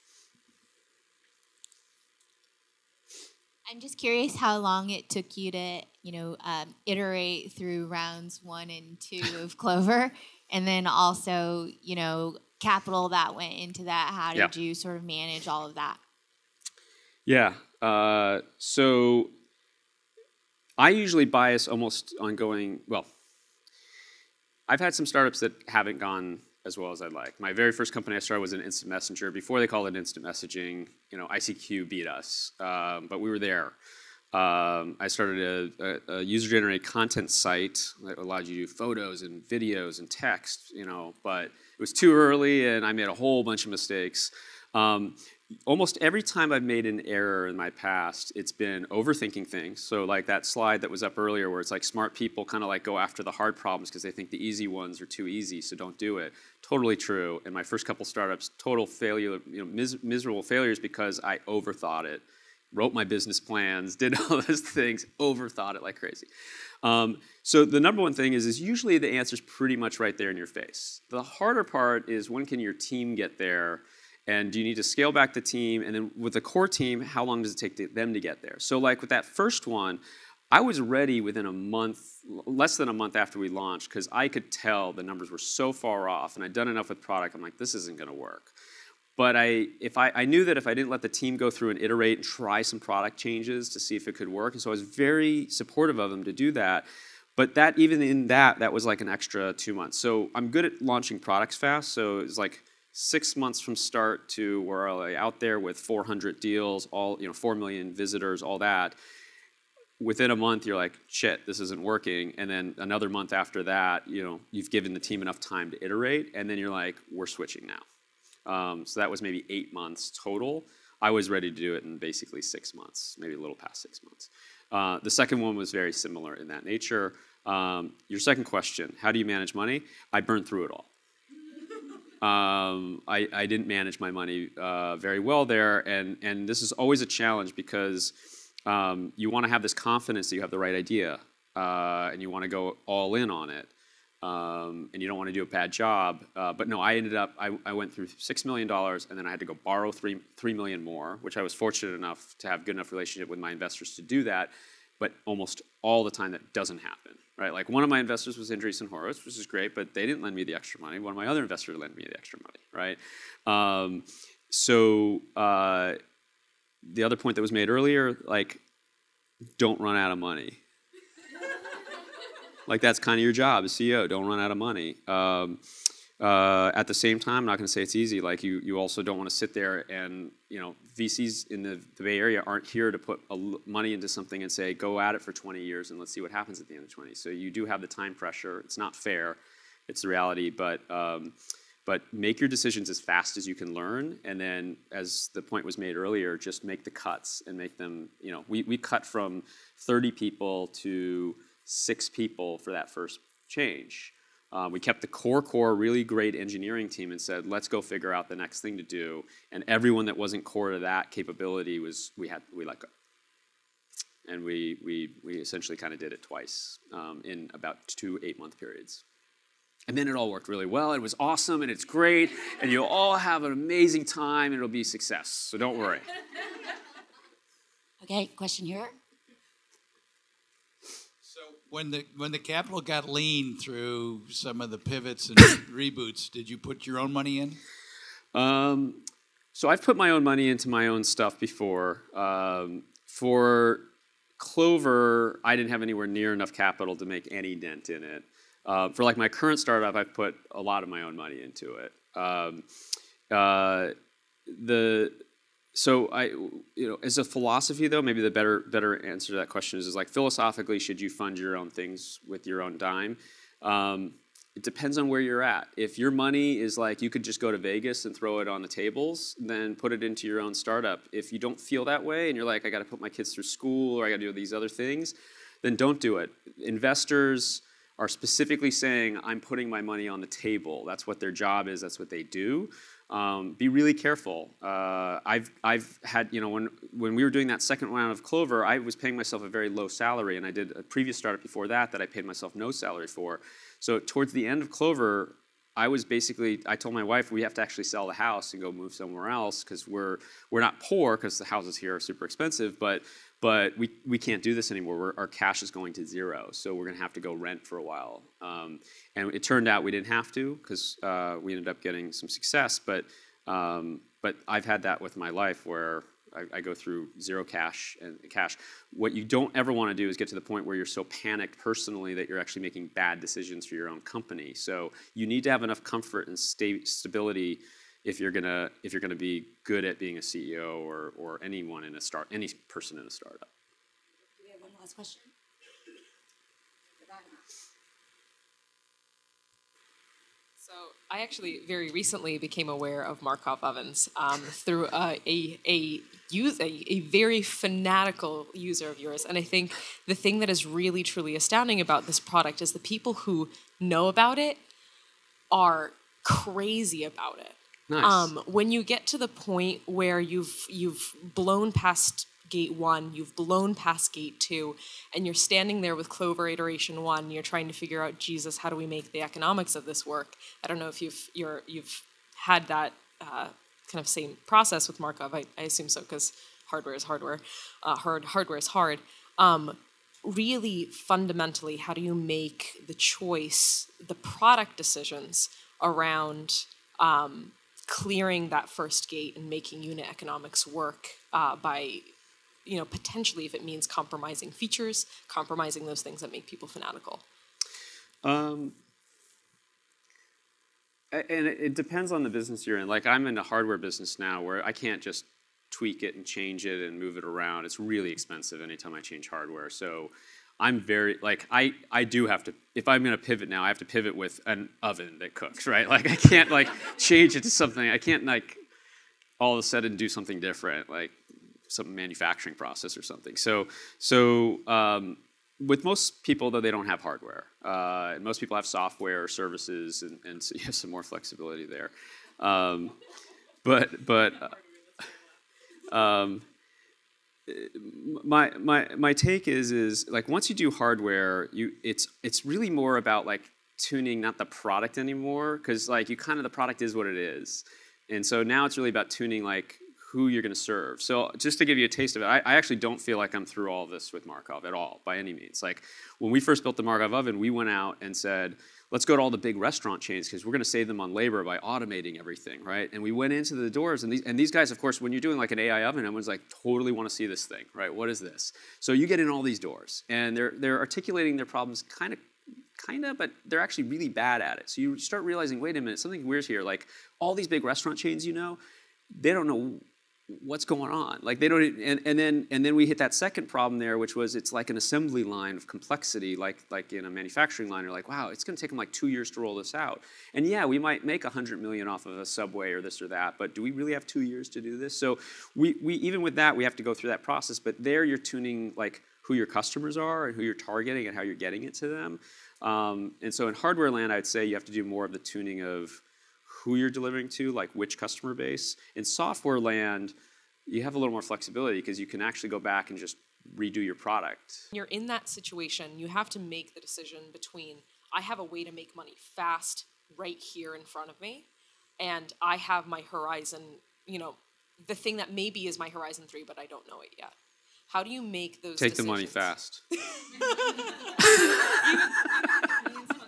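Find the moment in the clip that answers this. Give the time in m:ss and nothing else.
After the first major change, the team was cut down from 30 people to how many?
3:21.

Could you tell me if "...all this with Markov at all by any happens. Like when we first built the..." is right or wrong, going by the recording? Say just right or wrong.
wrong.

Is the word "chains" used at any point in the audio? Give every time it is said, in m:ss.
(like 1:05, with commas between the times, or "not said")
7:40, 7:57.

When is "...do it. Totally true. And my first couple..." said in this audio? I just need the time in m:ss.
0:55.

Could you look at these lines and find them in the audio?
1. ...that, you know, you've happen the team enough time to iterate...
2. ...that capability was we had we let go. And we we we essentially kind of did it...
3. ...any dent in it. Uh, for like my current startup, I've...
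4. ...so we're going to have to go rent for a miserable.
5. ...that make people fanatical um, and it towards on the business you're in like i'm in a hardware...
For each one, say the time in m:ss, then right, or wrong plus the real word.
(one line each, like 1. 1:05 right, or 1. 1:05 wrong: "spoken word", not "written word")
1. 1:53 wrong: "given", not "happen"
2. 3:30 right
3. 4:07 right
4. 5:06 wrong: "while", not "miserable"
5. 6:36 wrong: "depends", not "towards".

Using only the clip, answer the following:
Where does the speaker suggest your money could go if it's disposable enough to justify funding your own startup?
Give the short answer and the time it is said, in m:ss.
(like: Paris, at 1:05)
Vegas, at 4:27.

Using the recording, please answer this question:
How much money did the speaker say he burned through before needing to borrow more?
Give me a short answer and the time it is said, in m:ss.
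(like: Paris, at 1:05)
$6 million, at 2:28.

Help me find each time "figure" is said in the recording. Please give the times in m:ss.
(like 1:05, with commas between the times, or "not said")
3:27, 6:07.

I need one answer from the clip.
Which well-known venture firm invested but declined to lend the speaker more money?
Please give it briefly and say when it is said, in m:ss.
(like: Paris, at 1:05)
Andreessen Horowitz, at 2:38.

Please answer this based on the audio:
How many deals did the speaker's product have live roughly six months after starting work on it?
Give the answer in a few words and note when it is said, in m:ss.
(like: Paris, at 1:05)
400, at 1:45.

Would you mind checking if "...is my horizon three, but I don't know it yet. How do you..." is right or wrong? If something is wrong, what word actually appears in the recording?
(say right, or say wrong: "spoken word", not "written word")
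right.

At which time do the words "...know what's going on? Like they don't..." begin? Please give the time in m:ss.
7:59.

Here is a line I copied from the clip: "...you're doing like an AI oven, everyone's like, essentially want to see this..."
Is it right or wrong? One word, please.
wrong.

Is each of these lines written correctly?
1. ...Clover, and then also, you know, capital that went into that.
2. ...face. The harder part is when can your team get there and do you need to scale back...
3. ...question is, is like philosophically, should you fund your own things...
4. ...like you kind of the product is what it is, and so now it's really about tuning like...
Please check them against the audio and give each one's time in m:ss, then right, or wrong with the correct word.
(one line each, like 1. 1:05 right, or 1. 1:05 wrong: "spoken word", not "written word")
1. 0:09 right
2. 1:10 right
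3. 4:19 right
4. 7:25 right.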